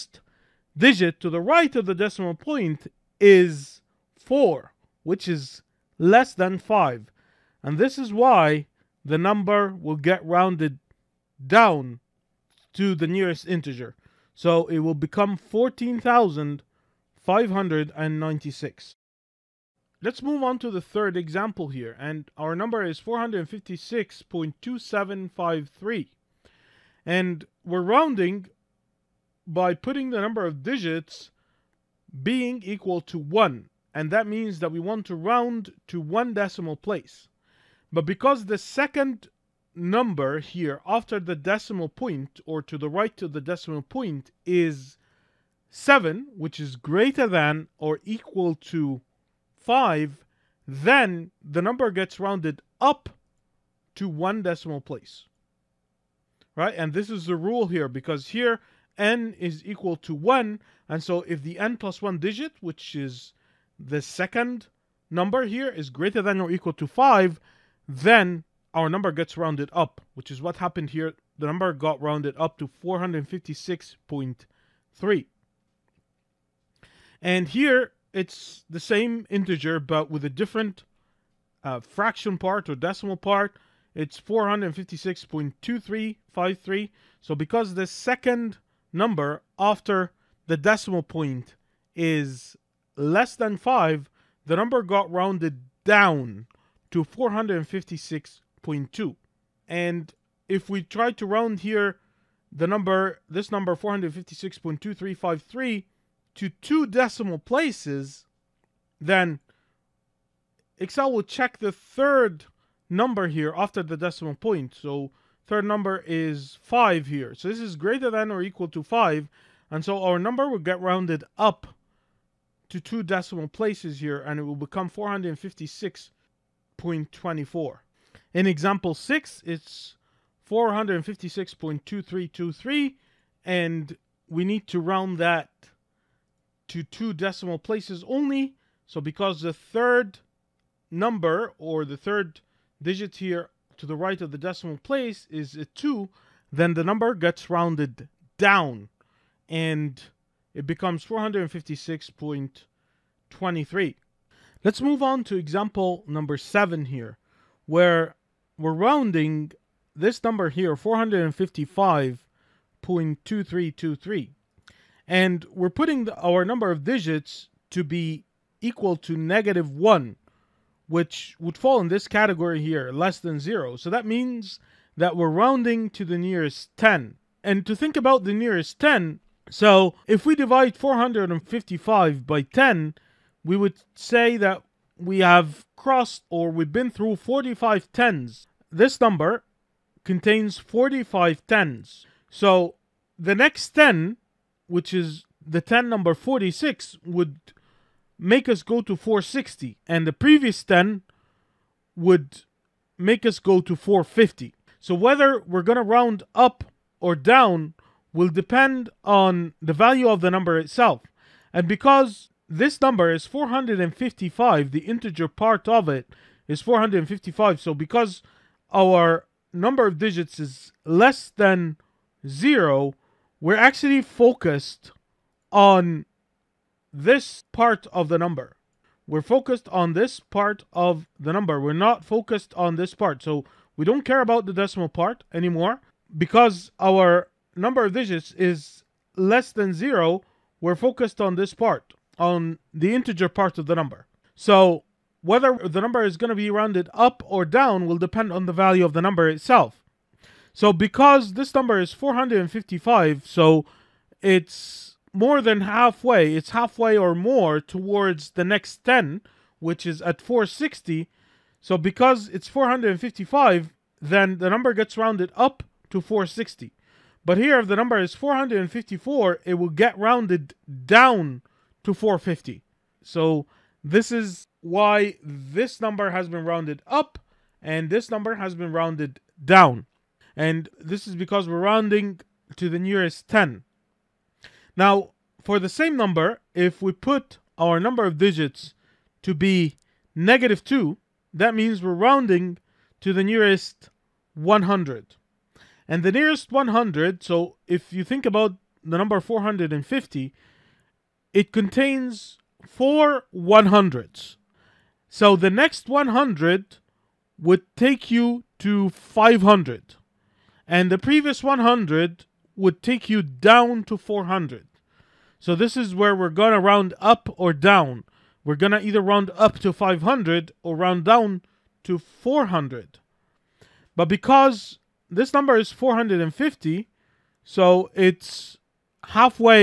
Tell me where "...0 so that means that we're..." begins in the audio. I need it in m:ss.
2:53.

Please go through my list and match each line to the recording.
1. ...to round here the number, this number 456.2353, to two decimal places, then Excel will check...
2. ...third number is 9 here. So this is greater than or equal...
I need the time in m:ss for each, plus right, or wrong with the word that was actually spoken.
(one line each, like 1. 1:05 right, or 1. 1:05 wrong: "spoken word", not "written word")
1. 1:41 right
2. 1:55 wrong: "5", not "9".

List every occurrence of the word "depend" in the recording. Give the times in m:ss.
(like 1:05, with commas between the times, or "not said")
3:28, 4:07.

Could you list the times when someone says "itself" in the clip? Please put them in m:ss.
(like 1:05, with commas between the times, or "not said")
3:30, 4:09.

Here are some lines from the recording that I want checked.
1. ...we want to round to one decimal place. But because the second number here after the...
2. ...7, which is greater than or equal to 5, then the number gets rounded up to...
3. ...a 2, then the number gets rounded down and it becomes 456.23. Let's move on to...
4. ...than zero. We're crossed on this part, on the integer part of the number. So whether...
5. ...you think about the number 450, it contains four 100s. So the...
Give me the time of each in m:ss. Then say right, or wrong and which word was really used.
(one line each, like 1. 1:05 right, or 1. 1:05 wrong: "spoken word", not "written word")
1. 0:34 right
2. 0:45 right
3. 2:25 right
4. 3:59 wrong: "focused", not "crossed"
5. 4:57 right.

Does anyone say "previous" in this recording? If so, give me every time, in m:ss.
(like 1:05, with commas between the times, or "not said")
3:20, 5:10.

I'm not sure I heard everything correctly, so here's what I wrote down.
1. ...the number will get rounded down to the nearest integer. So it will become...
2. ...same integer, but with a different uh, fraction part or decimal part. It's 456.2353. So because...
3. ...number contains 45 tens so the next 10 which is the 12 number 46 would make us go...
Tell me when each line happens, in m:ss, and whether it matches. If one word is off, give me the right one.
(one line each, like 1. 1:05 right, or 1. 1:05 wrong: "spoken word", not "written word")
1. 0:09 right
2. 1:18 right
3. 3:09 wrong: "10", not "12".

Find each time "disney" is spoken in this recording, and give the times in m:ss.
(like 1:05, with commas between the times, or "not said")
not said.